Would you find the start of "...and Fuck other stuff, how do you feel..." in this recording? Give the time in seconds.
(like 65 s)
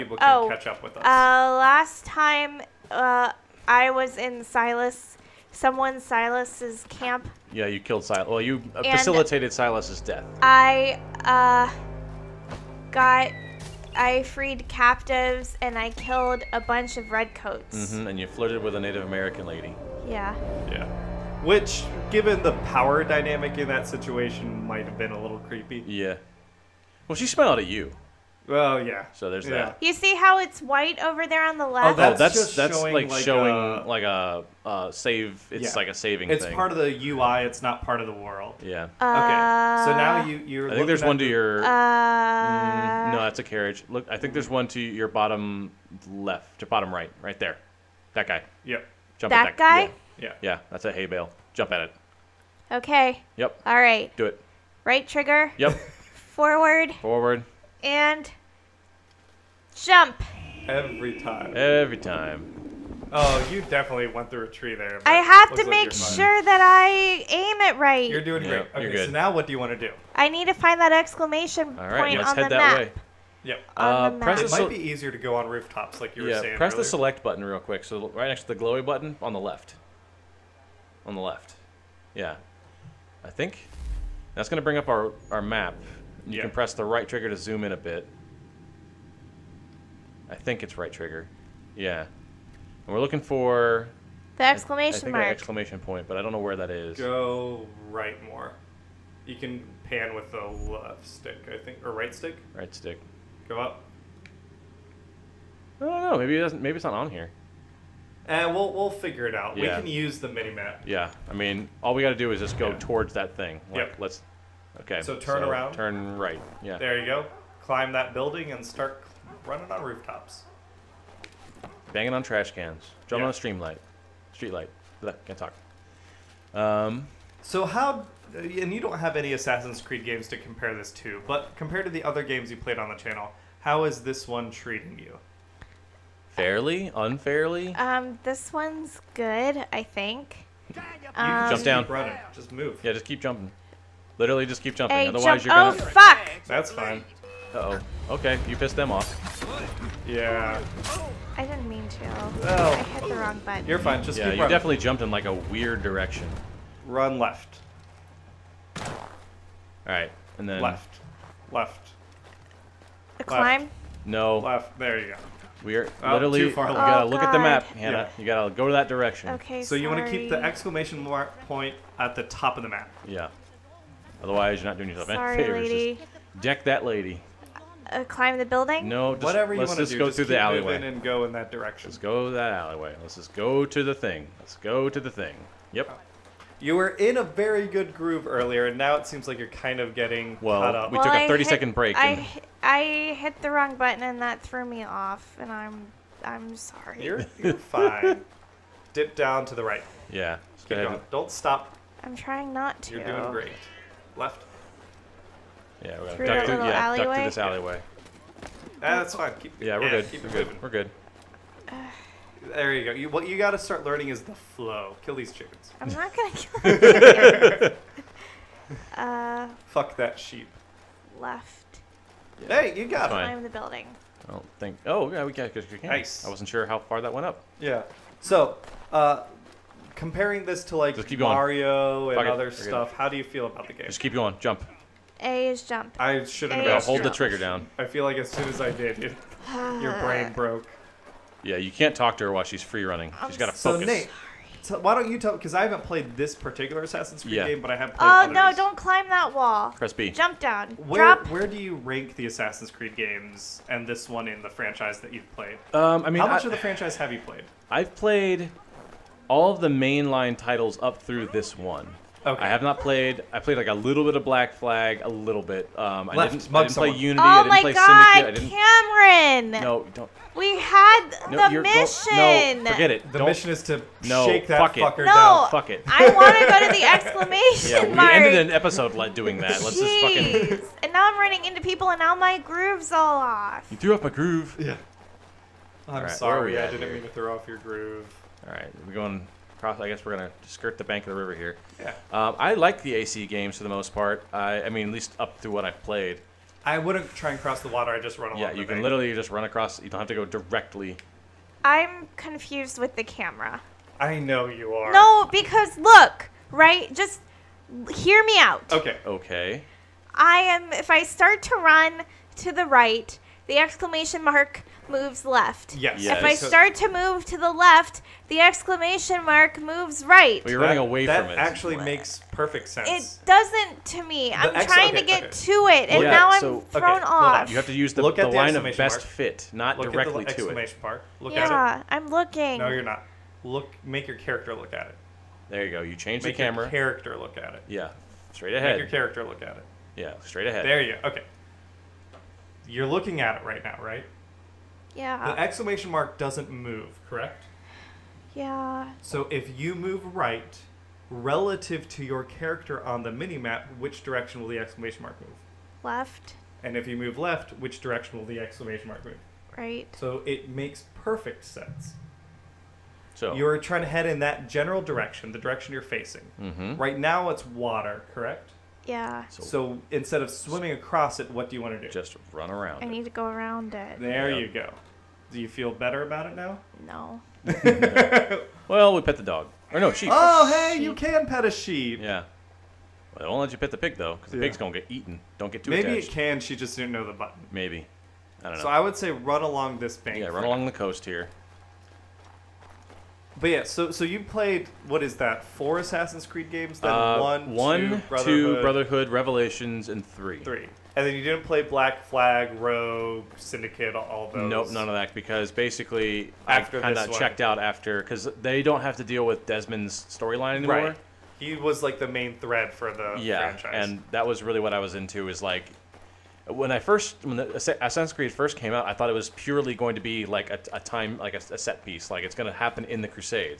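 232 s.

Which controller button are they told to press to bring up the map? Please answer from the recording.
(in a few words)
Select button.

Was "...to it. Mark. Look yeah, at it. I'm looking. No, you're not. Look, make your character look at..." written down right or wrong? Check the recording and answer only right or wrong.
right.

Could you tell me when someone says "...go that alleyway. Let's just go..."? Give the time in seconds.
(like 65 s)
181 s.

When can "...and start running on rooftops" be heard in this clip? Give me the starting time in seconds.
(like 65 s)
118 s.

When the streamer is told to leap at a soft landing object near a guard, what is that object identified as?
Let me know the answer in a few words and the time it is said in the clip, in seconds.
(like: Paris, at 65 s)
A hay bale, at 50 s.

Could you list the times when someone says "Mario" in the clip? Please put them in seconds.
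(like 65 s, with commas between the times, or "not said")
231 s.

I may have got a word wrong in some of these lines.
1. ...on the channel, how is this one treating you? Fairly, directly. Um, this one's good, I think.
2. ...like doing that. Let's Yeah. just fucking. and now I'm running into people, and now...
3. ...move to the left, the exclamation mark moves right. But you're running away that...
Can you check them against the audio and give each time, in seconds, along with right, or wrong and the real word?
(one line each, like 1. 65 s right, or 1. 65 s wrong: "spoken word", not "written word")
1. 132 s wrong: "unfairly", not "directly"
2. 278 s wrong: "Jeez", not "Yeah"
3. 316 s right.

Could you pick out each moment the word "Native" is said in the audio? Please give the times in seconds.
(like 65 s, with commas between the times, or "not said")
18 s.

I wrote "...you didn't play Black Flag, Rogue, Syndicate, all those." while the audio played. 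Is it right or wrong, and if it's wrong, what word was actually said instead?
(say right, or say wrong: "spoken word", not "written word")
right.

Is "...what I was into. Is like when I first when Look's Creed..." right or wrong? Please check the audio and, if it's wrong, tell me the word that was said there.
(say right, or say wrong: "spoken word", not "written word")
wrong: "Assassin", not "Look".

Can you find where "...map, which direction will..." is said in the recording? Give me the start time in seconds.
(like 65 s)
353 s.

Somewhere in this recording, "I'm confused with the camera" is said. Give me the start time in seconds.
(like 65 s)
301 s.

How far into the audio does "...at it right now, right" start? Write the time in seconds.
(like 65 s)
343 s.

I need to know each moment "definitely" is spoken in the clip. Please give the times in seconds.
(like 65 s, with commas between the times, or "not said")
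63 s, 154 s.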